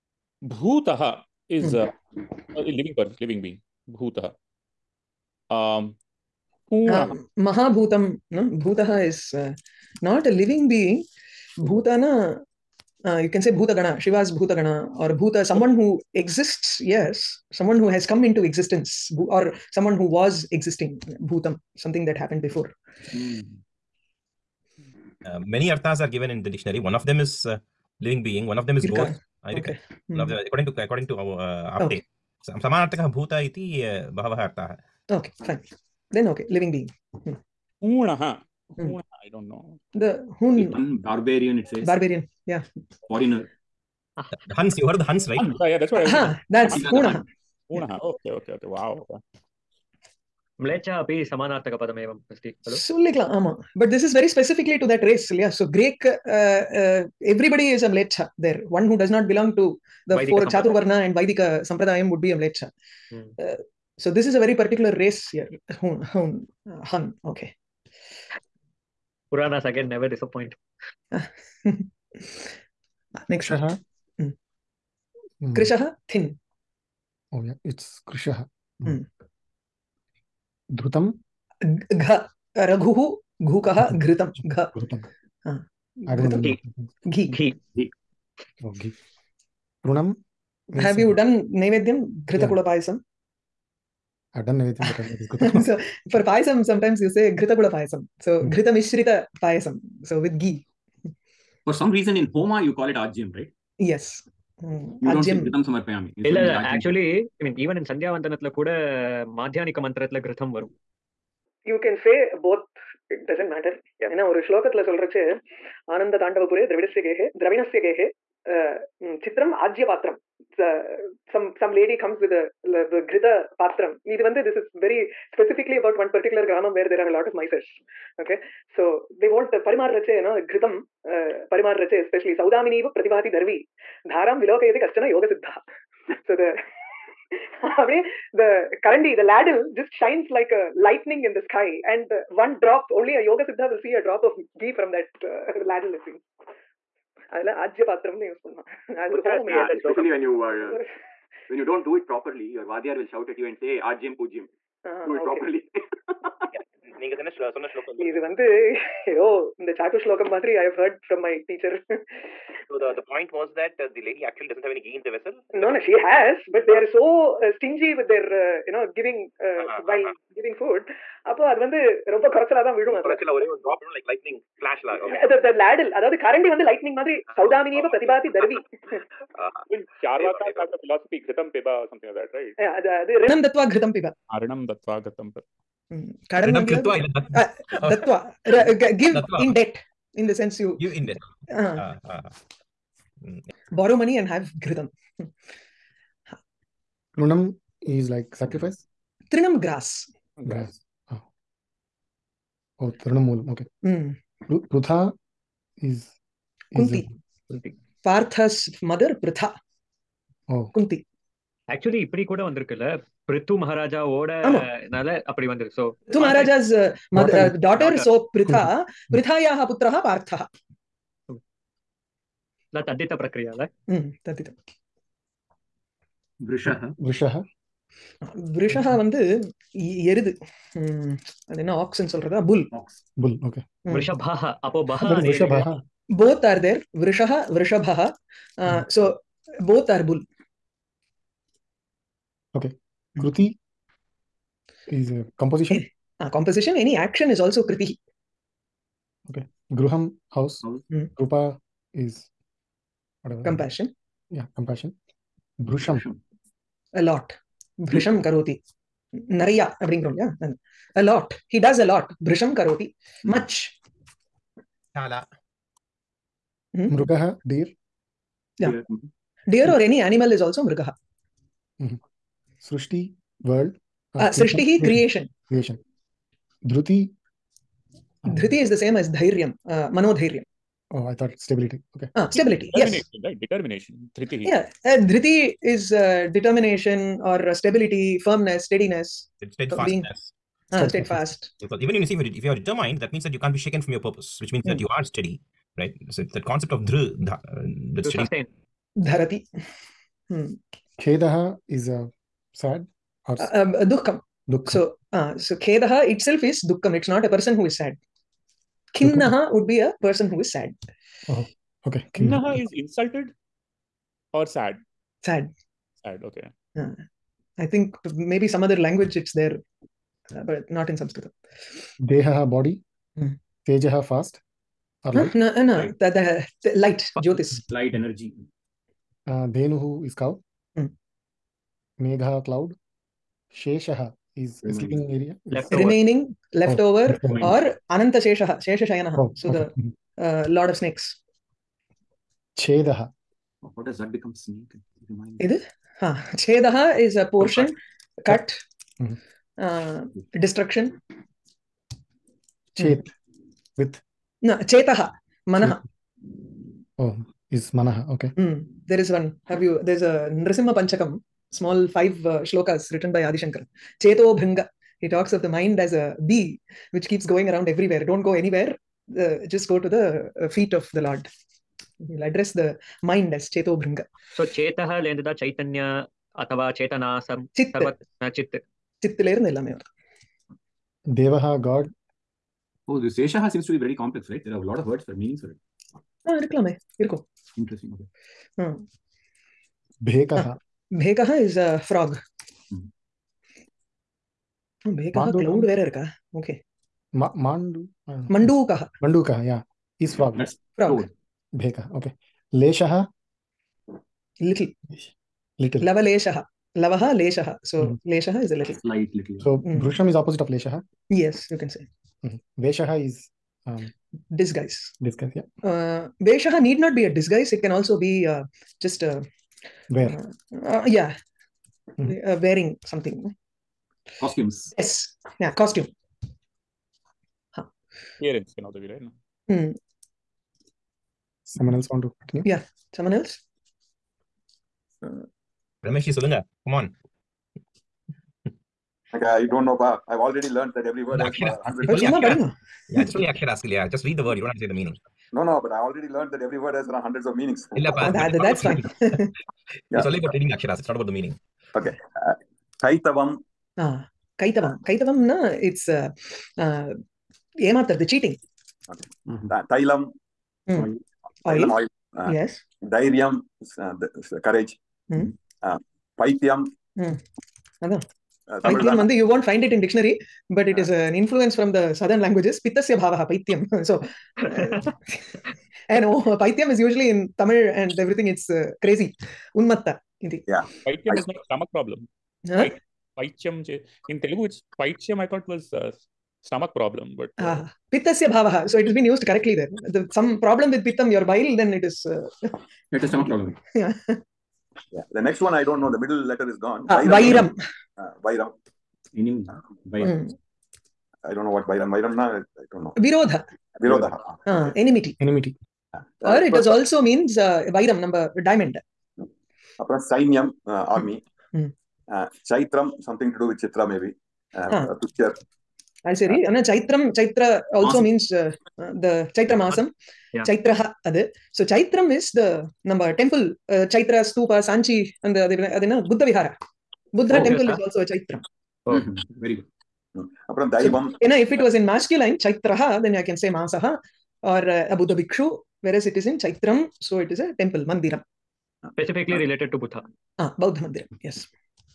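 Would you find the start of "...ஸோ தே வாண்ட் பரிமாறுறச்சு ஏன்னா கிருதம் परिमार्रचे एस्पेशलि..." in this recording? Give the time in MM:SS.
02:08.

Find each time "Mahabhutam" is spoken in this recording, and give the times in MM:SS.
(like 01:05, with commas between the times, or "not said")
00:06.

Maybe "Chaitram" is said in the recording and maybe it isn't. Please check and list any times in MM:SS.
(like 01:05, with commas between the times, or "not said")
08:32, 08:56.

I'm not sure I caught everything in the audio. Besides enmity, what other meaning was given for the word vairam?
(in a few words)
diamond.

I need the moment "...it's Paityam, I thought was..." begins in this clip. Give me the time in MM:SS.
08:04.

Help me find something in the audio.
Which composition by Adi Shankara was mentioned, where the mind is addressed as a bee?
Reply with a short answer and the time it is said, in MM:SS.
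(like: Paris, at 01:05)
Nrisimha Panchakam, at 06:00.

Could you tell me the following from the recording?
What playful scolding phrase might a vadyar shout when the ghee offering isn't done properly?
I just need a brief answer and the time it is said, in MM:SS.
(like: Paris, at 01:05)
Ajim Pujim, at 02:33.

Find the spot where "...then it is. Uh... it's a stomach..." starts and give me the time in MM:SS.
08:11.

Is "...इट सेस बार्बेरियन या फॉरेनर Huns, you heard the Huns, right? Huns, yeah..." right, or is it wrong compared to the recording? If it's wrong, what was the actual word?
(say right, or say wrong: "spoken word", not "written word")
right.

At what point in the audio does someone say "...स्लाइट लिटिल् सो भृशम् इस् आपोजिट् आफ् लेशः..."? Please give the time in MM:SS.
06:48.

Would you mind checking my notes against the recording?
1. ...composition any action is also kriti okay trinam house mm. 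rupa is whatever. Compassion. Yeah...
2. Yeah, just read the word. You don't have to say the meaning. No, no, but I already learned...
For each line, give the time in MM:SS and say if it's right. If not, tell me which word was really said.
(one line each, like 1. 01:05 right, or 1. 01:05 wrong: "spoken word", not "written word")
1. 04:06 wrong: "gruham", not "trinam"
2. 07:23 right.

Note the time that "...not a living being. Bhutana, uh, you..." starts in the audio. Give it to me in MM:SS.
00:10.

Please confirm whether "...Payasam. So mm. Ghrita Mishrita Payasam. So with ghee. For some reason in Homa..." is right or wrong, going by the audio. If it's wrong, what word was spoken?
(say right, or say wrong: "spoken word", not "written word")
right.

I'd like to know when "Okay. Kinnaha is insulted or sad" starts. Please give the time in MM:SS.
05:11.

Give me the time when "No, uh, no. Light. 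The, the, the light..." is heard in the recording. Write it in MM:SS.
05:25.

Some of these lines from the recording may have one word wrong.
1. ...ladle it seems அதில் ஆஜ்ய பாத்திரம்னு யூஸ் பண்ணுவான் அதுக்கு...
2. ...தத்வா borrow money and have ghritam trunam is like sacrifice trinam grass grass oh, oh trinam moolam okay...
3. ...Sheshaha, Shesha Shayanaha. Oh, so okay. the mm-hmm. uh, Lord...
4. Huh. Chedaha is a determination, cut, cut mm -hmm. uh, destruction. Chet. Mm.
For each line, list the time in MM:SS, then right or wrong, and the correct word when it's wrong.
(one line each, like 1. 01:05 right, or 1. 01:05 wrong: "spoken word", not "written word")
1. 02:25 right
2. 03:09 right
3. 05:38 right
4. 05:45 wrong: "portion", not "determination".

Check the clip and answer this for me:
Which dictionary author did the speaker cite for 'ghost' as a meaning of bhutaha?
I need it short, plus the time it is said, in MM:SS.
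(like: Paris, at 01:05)
Apte, at 00:31.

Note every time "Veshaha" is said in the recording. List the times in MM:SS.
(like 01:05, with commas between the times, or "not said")
06:56.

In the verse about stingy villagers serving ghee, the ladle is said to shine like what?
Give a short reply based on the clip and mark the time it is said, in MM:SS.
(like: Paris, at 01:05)
lightning, at 02:20.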